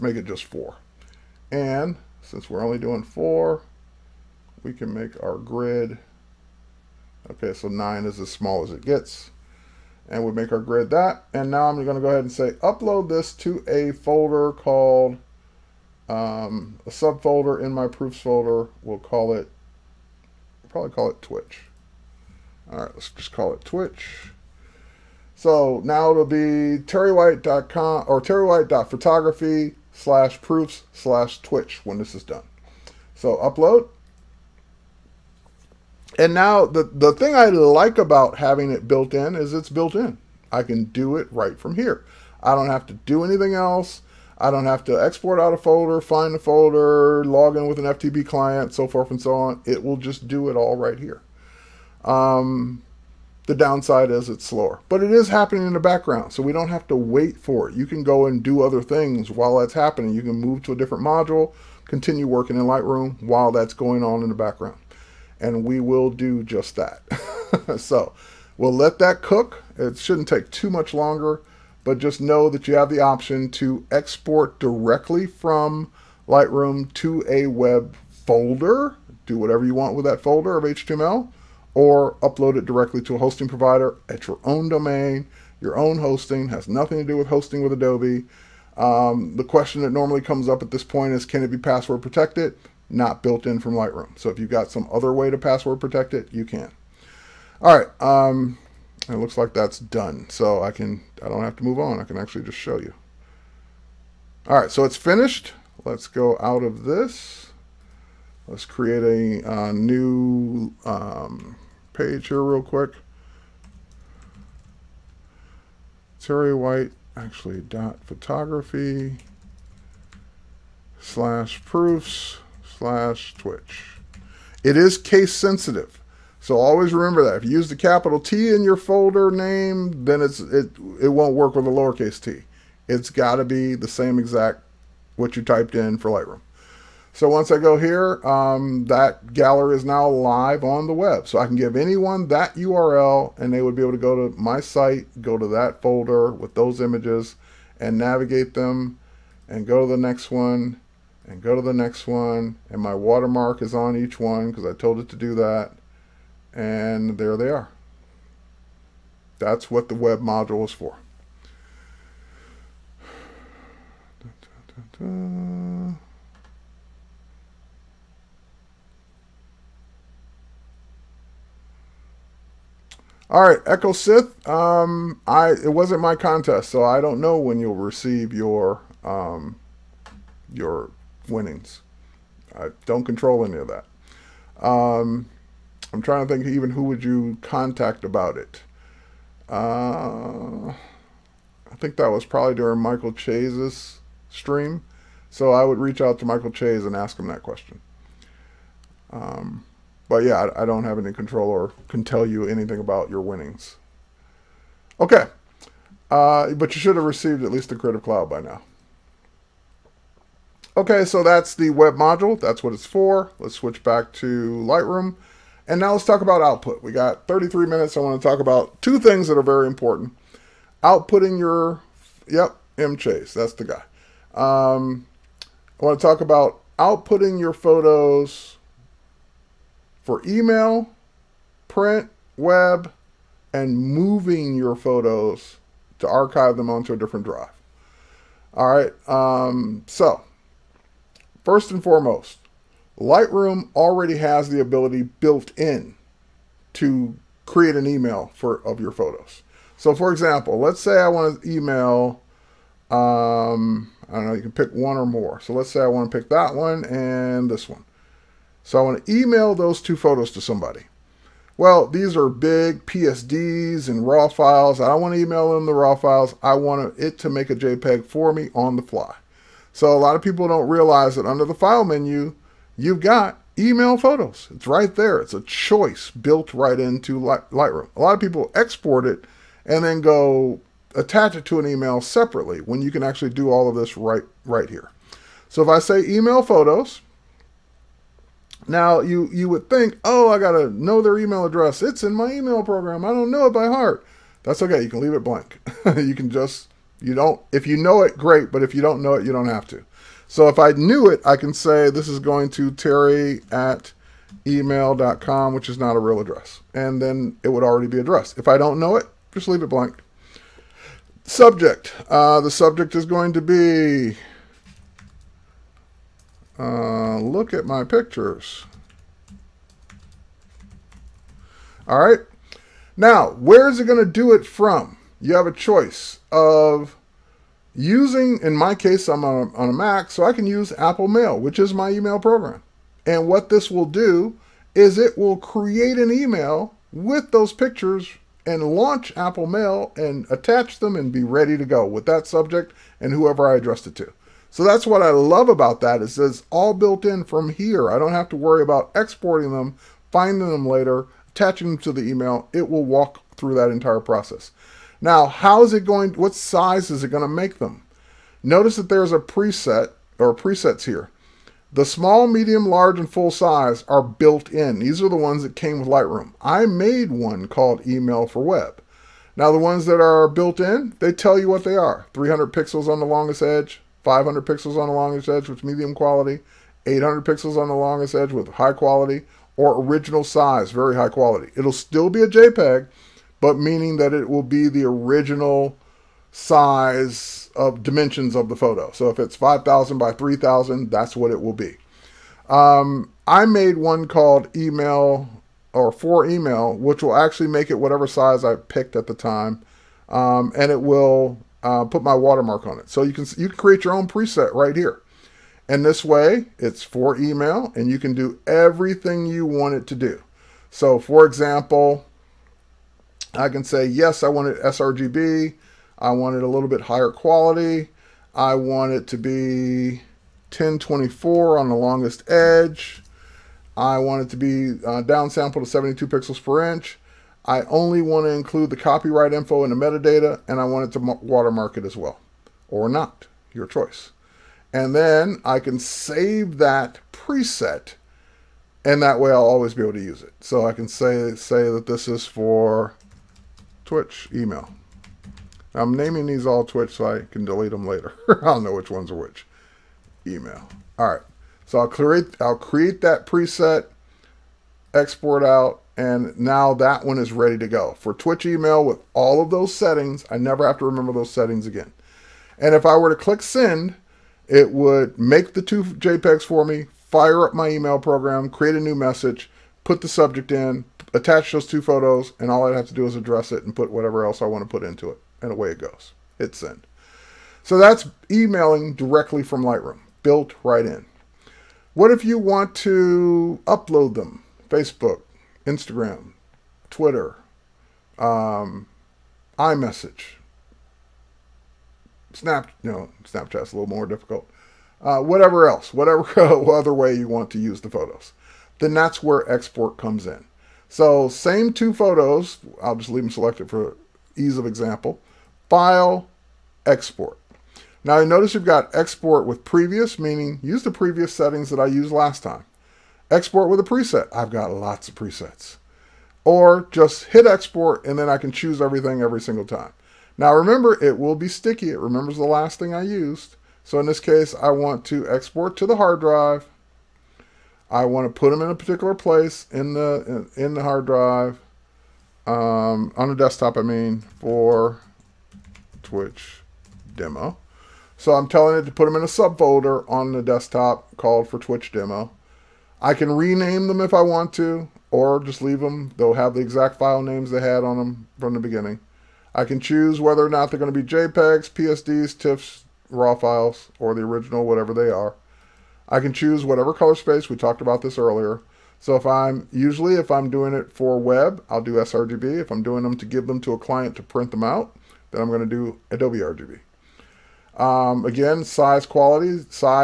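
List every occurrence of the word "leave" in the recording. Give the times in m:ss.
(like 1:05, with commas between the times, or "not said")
4:54, 5:09, 8:23, 9:05.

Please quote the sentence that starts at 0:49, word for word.
It will just do it all right here.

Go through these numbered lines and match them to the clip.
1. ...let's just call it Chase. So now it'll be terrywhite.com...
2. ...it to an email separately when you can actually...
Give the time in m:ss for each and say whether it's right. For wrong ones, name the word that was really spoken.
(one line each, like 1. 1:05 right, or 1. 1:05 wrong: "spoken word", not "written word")
1. 0:22 wrong: "Twitch", not "Chase"
2. 4:41 right.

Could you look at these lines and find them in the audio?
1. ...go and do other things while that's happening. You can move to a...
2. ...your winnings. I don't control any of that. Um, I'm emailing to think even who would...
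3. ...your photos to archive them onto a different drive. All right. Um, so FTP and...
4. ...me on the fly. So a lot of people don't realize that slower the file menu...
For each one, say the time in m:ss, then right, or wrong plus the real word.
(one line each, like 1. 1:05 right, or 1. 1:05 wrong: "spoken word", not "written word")
1. 0:58 right
2. 3:00 wrong: "trying", not "emailing"
3. 3:54 wrong: "First", not "FTP"
4. 4:28 wrong: "under", not "slower".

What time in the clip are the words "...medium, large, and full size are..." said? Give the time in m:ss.
6:02.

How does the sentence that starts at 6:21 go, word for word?
It'll still be a JPEG, but meaning that it will be the original size of dimensions of the photo.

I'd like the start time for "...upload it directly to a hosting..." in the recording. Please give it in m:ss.
1:22.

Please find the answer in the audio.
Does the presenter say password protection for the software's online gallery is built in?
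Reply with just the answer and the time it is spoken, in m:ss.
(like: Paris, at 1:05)
not built in, at 1:32.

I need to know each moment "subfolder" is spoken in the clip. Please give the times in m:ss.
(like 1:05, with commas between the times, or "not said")
0:16, 8:59.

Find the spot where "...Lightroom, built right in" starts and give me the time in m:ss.
7:59.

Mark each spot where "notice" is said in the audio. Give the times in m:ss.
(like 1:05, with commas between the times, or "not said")
5:58, 8:28.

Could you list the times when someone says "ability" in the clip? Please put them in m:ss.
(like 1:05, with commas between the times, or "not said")
4:04.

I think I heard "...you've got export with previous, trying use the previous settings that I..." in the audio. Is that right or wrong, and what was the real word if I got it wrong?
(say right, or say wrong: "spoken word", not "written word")
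wrong: "meaning", not "trying".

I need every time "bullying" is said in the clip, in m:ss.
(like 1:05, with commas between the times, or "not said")
not said.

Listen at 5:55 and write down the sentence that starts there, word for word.
Now, how is it going, what size is it going to make them?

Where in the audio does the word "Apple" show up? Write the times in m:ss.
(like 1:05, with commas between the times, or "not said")
5:30, 5:39.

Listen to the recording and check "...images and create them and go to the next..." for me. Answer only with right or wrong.
wrong.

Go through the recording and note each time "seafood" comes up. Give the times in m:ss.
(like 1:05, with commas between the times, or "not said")
not said.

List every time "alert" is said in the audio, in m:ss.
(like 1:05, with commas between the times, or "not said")
not said.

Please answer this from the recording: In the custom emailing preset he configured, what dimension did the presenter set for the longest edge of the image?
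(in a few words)
1024.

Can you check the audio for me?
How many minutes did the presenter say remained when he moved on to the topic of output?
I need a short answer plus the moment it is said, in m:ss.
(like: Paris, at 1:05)
33, at 3:37.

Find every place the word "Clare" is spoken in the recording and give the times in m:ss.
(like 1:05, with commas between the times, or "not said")
not said.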